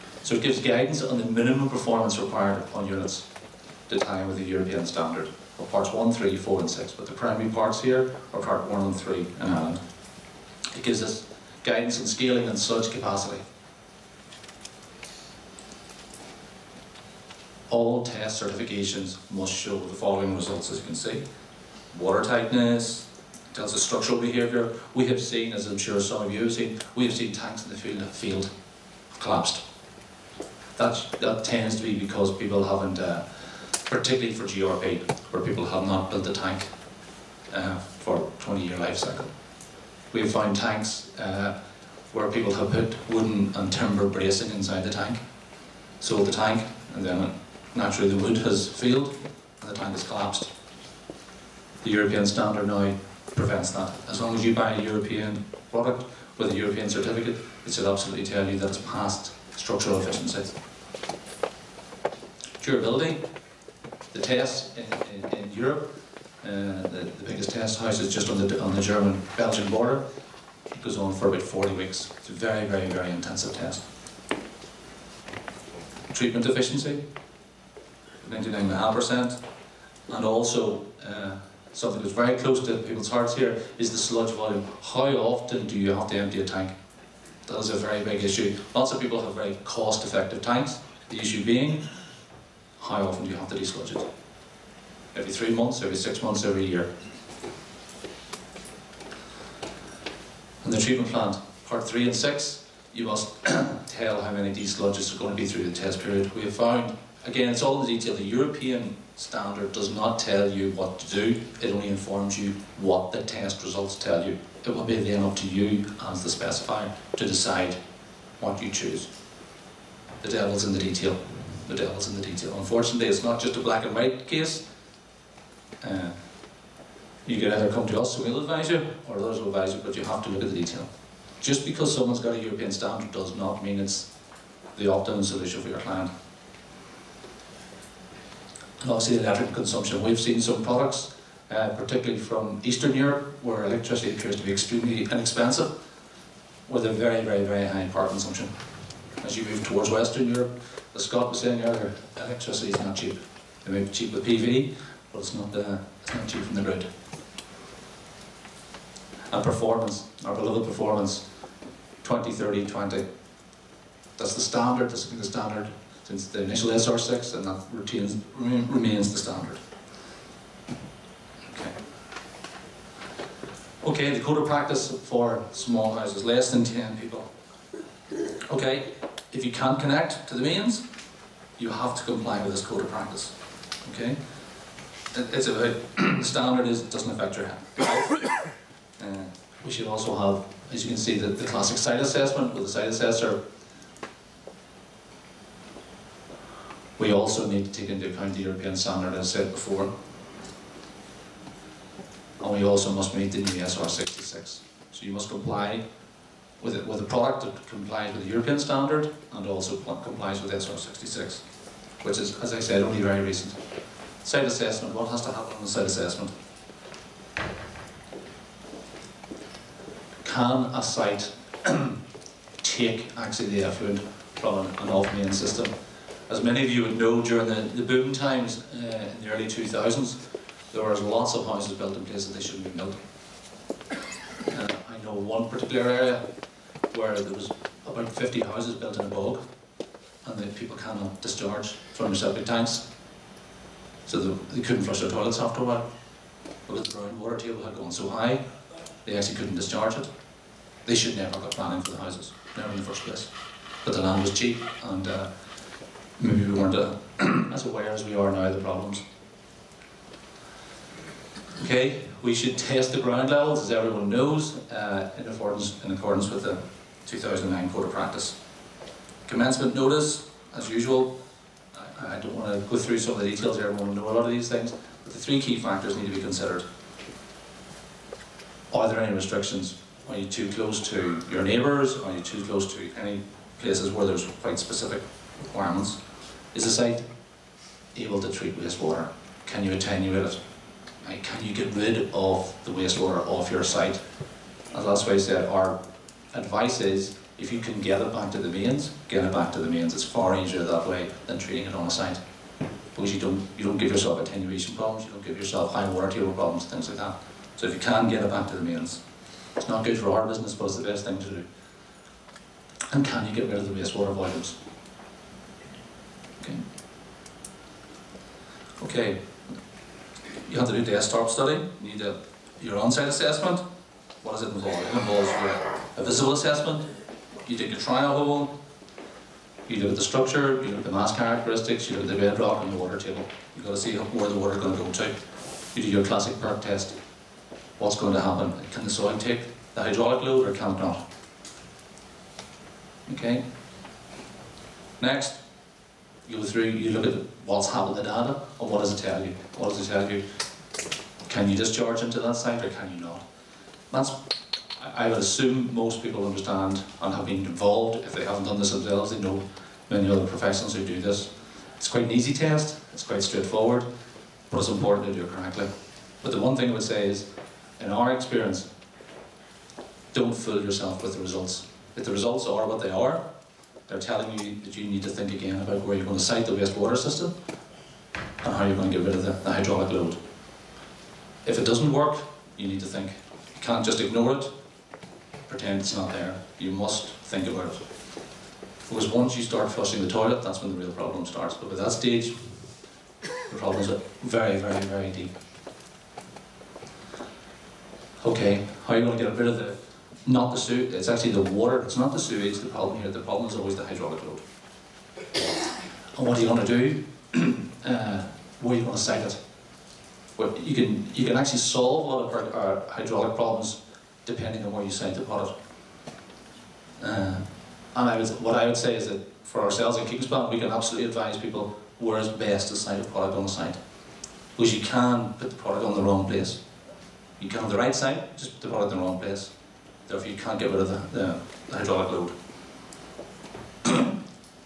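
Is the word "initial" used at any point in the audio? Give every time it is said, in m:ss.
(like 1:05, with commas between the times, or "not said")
2:46.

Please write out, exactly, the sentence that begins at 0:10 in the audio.
It gives us guidance on scaling and surge capacity.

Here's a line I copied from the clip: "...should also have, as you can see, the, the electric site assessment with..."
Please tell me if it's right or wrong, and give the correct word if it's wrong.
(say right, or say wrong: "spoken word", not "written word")
wrong: "classic", not "electric".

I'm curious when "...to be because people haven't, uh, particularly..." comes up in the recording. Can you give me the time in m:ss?
0:31.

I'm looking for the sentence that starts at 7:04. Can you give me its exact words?
Because you can put the product on the wrong place.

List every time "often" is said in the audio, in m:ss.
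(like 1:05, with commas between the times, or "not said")
1:25, 1:33.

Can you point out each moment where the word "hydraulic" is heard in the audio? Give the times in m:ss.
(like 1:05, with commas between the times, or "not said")
5:39, 6:19, 6:43, 6:52, 7:11.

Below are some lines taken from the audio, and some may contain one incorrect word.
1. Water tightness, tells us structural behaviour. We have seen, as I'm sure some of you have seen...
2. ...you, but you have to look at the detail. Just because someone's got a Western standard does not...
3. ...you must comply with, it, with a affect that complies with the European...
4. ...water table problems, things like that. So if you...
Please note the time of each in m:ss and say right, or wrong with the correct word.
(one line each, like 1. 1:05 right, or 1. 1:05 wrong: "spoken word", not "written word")
1. 0:21 right
2. 2:09 wrong: "European", not "Western"
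3. 3:25 wrong: "product", not "affect"
4. 5:05 right.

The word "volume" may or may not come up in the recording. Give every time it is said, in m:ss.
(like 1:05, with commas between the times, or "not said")
1:24, 5:14.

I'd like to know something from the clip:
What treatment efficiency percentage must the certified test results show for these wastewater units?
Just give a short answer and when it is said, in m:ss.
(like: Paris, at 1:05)
99.5%, at 1:18.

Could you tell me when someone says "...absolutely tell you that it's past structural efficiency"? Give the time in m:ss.
0:57.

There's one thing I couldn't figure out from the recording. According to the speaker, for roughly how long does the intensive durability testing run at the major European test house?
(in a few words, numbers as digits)
40 weeks.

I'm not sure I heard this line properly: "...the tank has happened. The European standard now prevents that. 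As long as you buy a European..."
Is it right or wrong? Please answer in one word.
wrong.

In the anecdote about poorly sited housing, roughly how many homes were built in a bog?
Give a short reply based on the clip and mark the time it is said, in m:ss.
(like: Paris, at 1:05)
50, at 3:57.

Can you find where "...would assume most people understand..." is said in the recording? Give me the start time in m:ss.
5:55.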